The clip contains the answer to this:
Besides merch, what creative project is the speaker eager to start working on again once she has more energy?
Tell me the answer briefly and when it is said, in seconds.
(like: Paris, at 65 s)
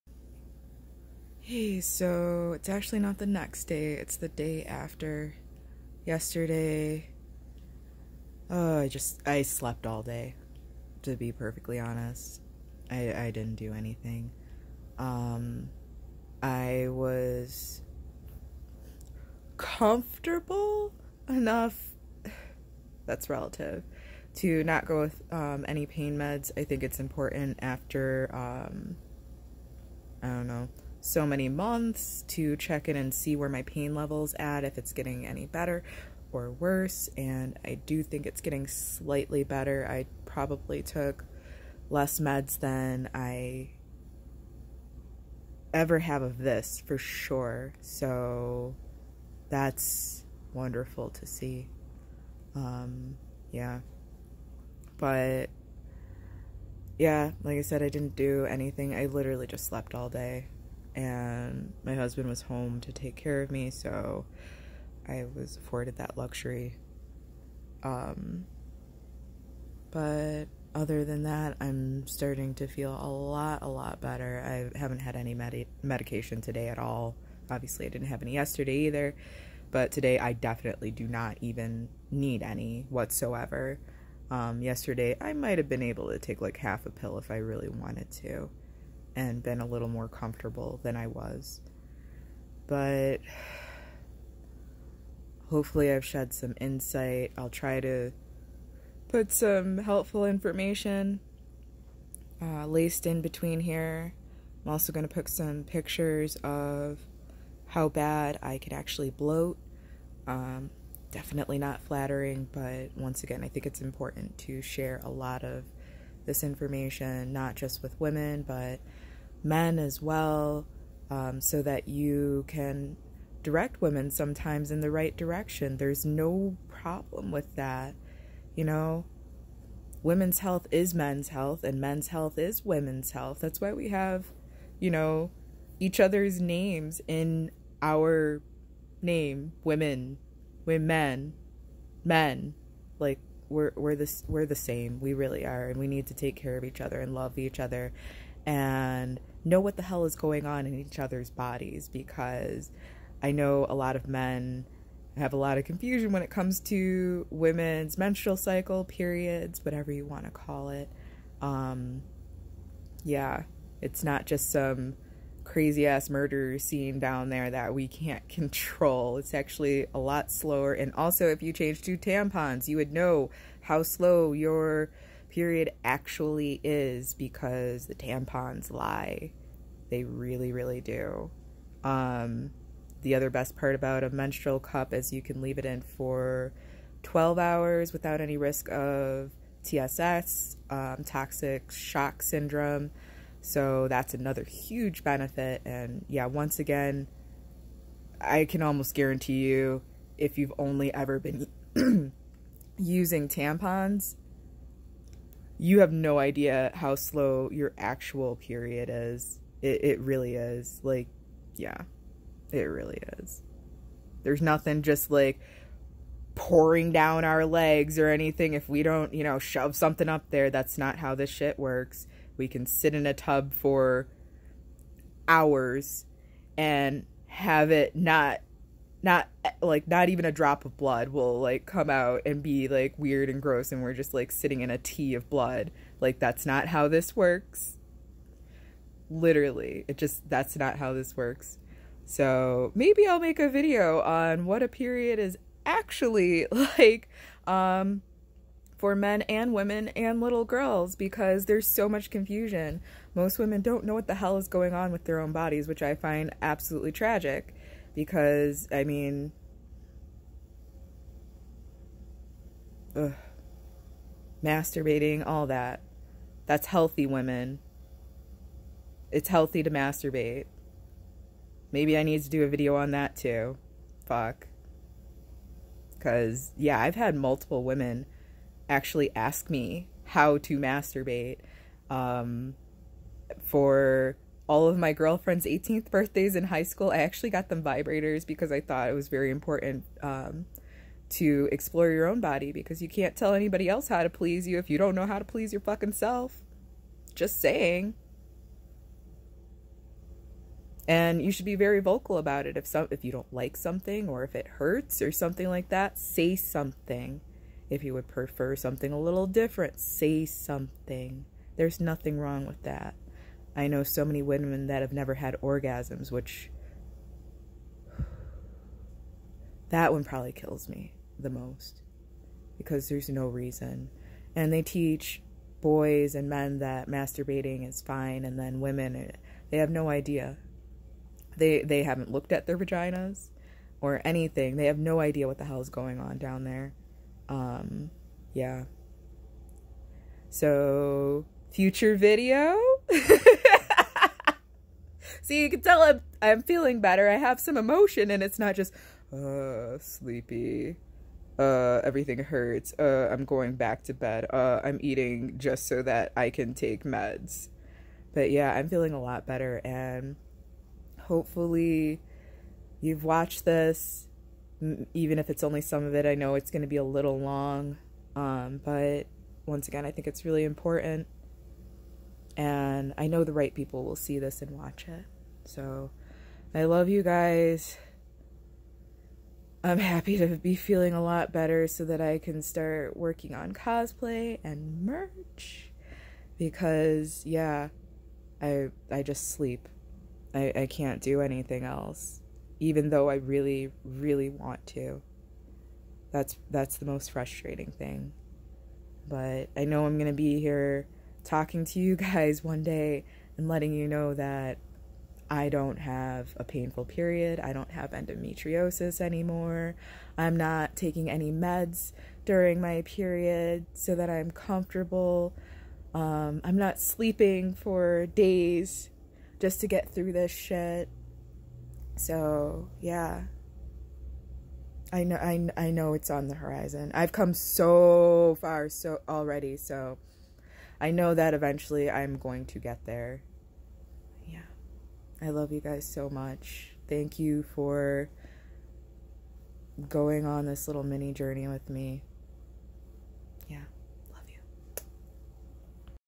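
Cosplay, at 383 s.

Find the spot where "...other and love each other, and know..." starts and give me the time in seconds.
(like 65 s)
146 s.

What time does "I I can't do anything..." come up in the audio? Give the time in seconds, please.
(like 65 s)
390 s.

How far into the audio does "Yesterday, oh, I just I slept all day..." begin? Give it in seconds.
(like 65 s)
6 s.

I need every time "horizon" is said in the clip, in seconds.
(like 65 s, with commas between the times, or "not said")
426 s.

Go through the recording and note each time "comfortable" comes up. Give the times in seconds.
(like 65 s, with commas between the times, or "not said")
19 s, 90 s, 414 s.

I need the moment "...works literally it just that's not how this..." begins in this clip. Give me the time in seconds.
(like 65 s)
237 s.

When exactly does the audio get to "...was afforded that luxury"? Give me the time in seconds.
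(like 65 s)
65 s.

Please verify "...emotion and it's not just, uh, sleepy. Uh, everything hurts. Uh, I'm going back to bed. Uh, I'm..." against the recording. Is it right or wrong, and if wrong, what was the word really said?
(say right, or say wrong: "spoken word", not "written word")
right.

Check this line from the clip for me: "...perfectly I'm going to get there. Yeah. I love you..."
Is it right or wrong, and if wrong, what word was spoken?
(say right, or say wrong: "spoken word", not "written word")
wrong: "eventually", not "perfectly".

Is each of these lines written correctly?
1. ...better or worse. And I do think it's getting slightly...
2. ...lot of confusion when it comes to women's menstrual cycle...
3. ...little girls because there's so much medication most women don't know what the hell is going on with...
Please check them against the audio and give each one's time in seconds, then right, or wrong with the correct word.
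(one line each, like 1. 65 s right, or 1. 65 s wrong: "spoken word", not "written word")
1. 35 s right
2. 155 s right
3. 250 s wrong: "confusion", not "medication".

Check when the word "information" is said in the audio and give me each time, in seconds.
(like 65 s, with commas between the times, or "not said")
100 s, 116 s.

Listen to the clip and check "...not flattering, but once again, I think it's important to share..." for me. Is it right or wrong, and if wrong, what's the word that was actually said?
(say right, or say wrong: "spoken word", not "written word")
right.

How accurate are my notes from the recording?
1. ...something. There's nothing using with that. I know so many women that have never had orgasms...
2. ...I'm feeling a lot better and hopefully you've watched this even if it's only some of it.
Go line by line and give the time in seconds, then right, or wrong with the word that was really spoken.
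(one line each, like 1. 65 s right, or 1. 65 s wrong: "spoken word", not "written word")
1. 310 s wrong: "wrong", not "using"
2. 358 s right.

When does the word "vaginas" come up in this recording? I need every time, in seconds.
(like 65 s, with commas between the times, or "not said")
332 s.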